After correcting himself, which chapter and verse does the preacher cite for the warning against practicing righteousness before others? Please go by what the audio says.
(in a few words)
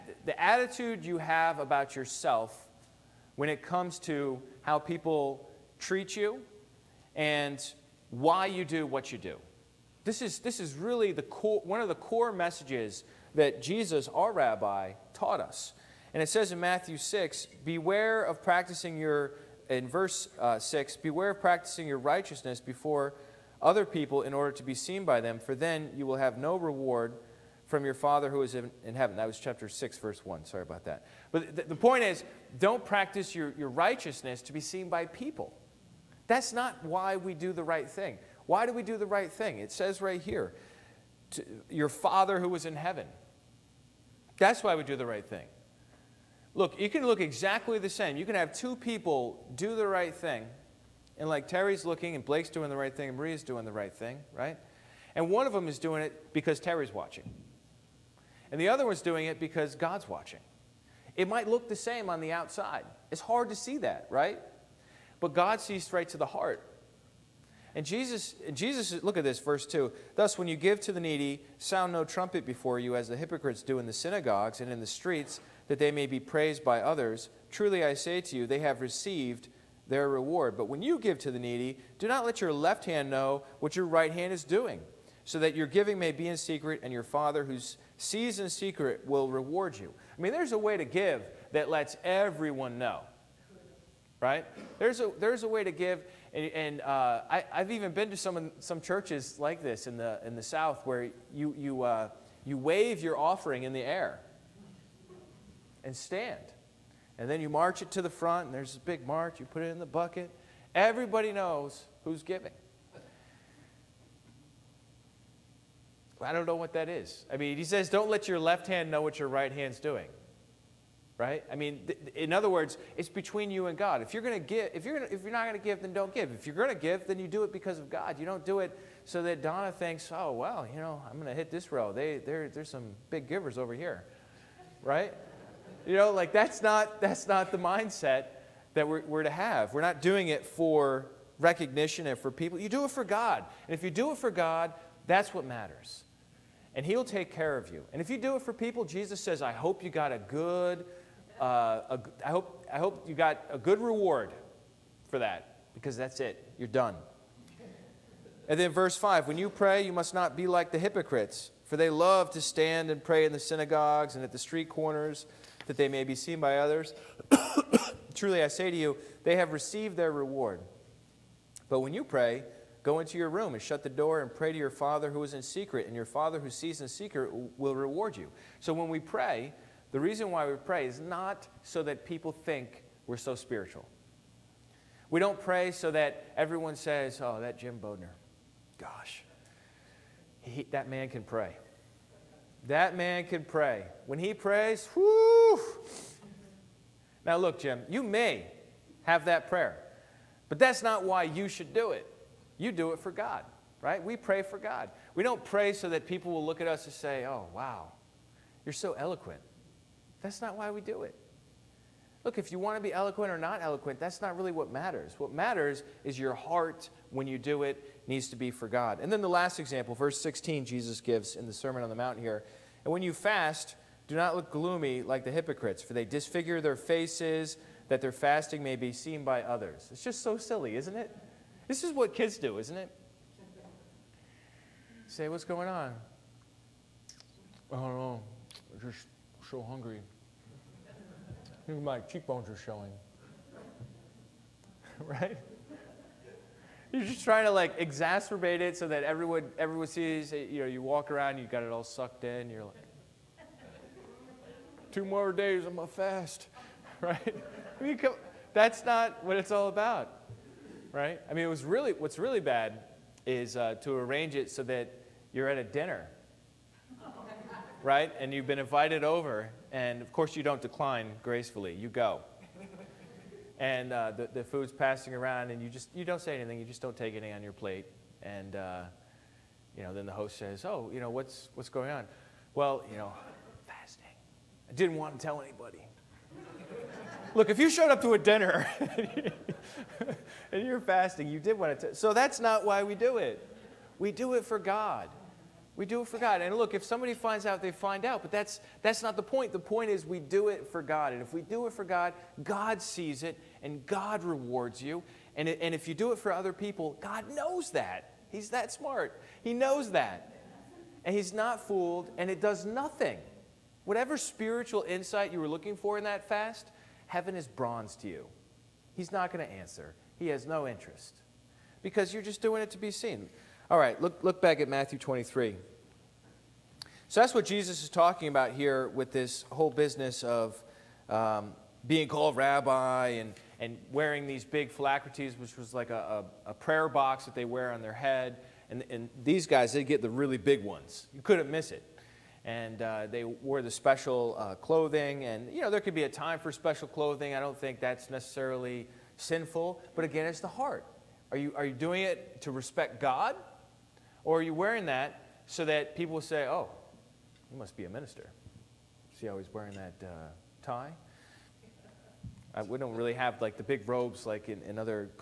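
Chapter 6, verse 1.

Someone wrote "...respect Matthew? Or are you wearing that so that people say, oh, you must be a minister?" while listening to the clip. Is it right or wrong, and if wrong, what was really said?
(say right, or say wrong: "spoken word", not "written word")
wrong: "God", not "Matthew".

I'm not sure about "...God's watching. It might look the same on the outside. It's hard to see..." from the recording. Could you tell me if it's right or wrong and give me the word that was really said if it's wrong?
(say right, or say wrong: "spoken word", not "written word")
right.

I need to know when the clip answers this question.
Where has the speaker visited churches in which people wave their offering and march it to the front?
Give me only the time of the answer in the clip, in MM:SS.
01:40.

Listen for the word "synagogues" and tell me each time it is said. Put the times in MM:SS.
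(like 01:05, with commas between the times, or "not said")
01:13, 02:43.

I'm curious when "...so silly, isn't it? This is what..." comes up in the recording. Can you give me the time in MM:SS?
03:50.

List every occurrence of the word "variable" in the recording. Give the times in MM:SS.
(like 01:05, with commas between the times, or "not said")
not said.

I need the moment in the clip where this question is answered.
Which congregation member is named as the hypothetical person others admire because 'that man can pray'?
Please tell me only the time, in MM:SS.
03:07.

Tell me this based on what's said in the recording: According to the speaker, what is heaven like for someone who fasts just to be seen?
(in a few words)
bronze.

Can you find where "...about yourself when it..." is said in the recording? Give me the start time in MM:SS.
00:01.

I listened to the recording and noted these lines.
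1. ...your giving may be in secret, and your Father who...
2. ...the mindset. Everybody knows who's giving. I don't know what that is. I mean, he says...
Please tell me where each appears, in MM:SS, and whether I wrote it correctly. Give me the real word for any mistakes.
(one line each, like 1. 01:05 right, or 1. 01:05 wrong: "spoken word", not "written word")
1. 01:25 right
2. 01:49 wrong: "bucket", not "mindset".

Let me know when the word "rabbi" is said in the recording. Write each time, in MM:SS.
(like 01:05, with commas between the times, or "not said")
00:14, 05:32.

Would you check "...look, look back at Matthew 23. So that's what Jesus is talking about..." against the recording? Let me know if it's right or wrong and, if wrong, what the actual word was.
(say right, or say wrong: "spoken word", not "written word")
right.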